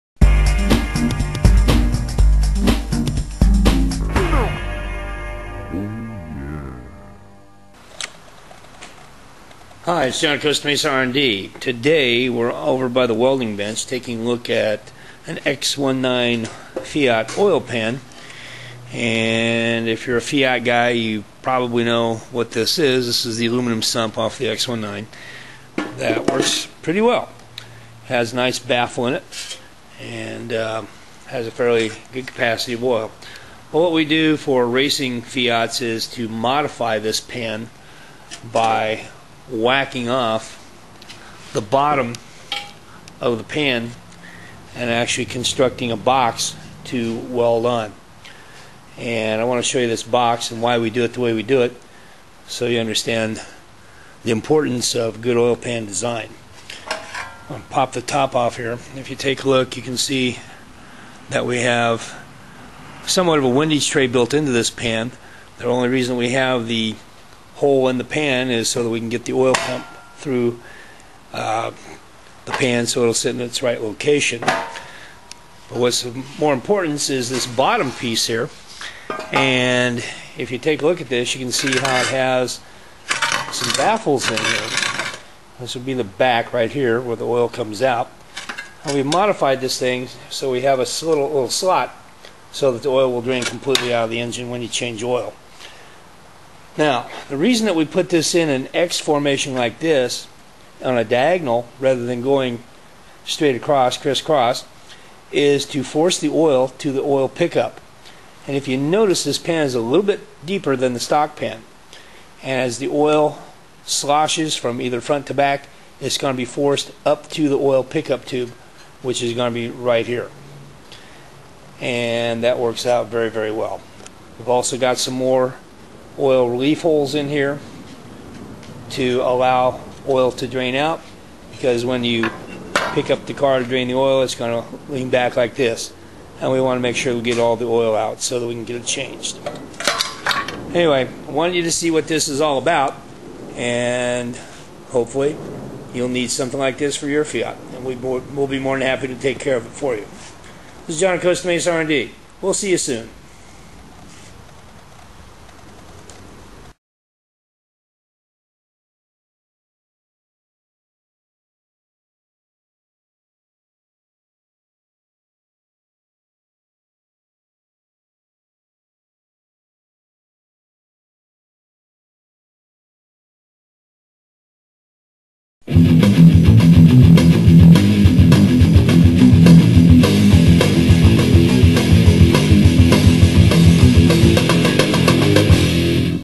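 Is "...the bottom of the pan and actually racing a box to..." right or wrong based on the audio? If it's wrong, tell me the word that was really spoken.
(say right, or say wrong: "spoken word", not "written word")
wrong: "constructing", not "racing".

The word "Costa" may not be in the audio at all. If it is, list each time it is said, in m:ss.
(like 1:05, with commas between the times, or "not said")
0:10, 2:31.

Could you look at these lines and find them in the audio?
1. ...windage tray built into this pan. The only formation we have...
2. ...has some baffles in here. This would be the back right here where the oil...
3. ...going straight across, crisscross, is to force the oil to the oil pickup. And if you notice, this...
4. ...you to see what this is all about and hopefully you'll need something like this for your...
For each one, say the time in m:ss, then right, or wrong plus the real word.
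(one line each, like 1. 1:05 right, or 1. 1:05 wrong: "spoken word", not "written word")
1. 1:03 wrong: "reason", not "formation"
2. 1:22 right
3. 1:42 right
4. 2:21 right.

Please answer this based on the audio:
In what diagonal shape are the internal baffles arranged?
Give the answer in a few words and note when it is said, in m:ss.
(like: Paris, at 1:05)
X formation, at 1:38.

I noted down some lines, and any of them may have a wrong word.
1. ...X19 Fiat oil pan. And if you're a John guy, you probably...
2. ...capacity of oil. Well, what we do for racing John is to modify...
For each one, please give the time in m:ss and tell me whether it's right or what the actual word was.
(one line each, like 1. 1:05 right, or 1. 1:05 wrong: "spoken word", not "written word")
1. 0:15 wrong: "Fiat", not "John"
2. 0:32 wrong: "Fiats", not "John".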